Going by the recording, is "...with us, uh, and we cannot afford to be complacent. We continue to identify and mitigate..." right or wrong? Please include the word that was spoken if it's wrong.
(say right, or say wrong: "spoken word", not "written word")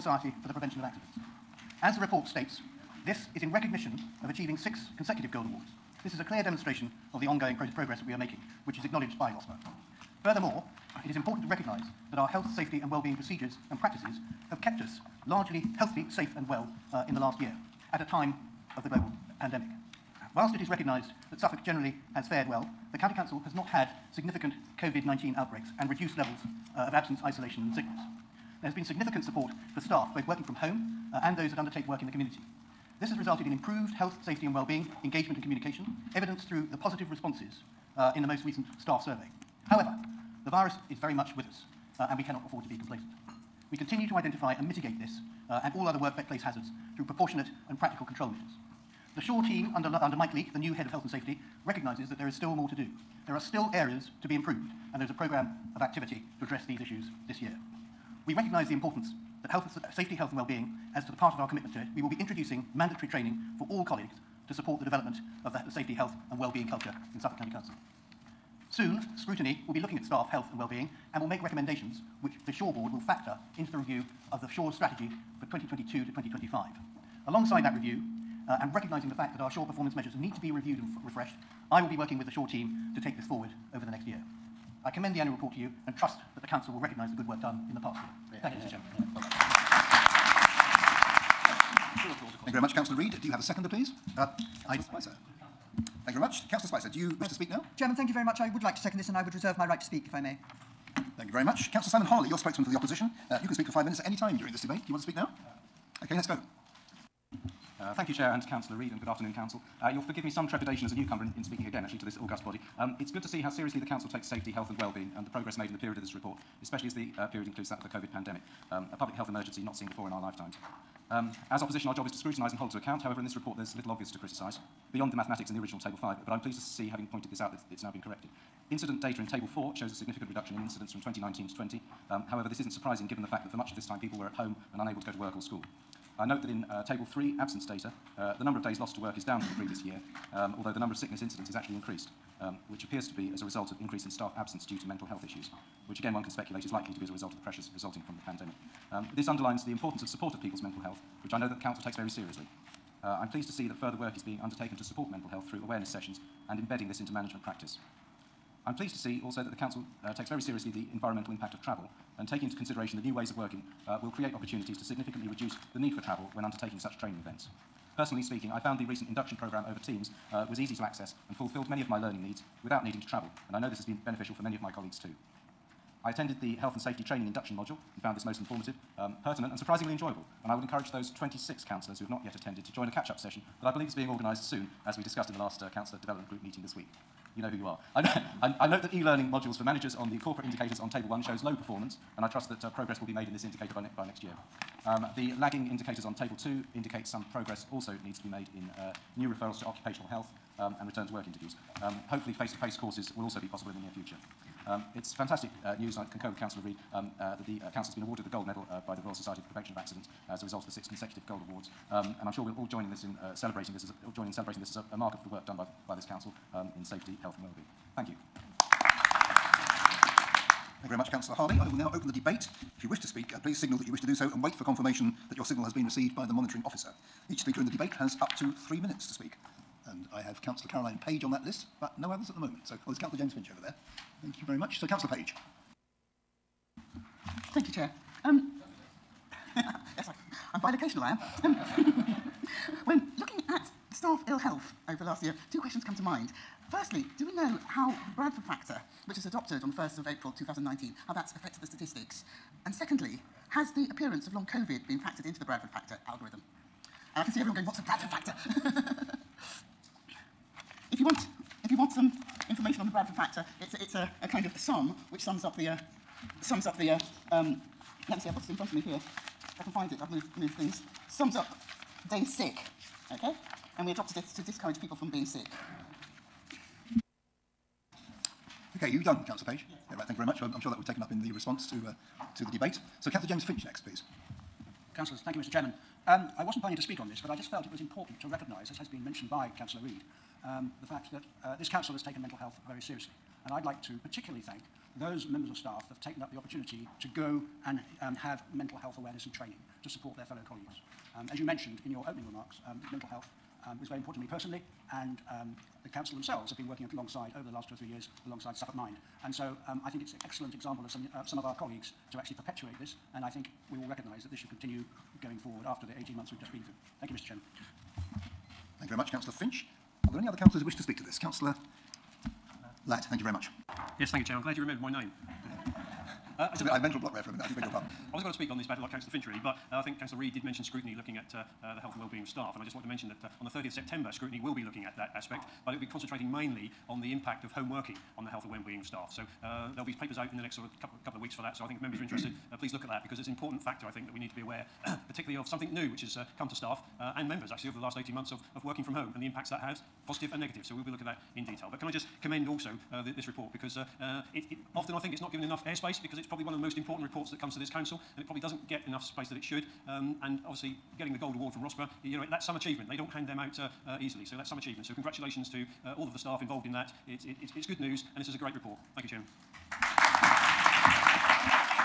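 right.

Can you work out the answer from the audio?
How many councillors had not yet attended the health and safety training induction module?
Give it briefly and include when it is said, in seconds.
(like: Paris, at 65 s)
26, at 181 s.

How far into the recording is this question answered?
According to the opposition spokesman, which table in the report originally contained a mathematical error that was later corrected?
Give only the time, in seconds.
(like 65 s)
125 s.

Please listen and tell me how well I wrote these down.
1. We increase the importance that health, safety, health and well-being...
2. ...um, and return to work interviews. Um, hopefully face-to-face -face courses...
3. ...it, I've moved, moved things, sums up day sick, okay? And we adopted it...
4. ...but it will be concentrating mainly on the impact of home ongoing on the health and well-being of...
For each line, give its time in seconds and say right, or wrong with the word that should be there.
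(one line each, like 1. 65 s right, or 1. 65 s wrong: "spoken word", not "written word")
1. 58 s wrong: "recognise", not "increase"
2. 200 s right
3. 269 s right
4. 335 s wrong: "working", not "ongoing".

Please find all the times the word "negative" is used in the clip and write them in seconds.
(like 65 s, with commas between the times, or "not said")
350 s.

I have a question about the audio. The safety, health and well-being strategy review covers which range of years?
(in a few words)
2022 to 2025.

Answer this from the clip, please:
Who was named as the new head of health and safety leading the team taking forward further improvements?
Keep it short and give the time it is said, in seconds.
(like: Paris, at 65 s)
Mike Leake, at 50 s.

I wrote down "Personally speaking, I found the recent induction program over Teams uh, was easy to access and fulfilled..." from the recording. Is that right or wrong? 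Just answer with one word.
right.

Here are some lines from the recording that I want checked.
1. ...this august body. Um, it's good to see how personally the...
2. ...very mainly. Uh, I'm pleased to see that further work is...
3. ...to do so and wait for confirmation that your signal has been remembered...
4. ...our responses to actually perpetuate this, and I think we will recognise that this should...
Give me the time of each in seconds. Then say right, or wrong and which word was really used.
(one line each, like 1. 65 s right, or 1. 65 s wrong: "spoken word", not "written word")
1. 112 s wrong: "seriously", not "personally"
2. 151 s wrong: "seriously", not "mainly"
3. 224 s wrong: "received", not "remembered"
4. 311 s wrong: "colleagues", not "responses".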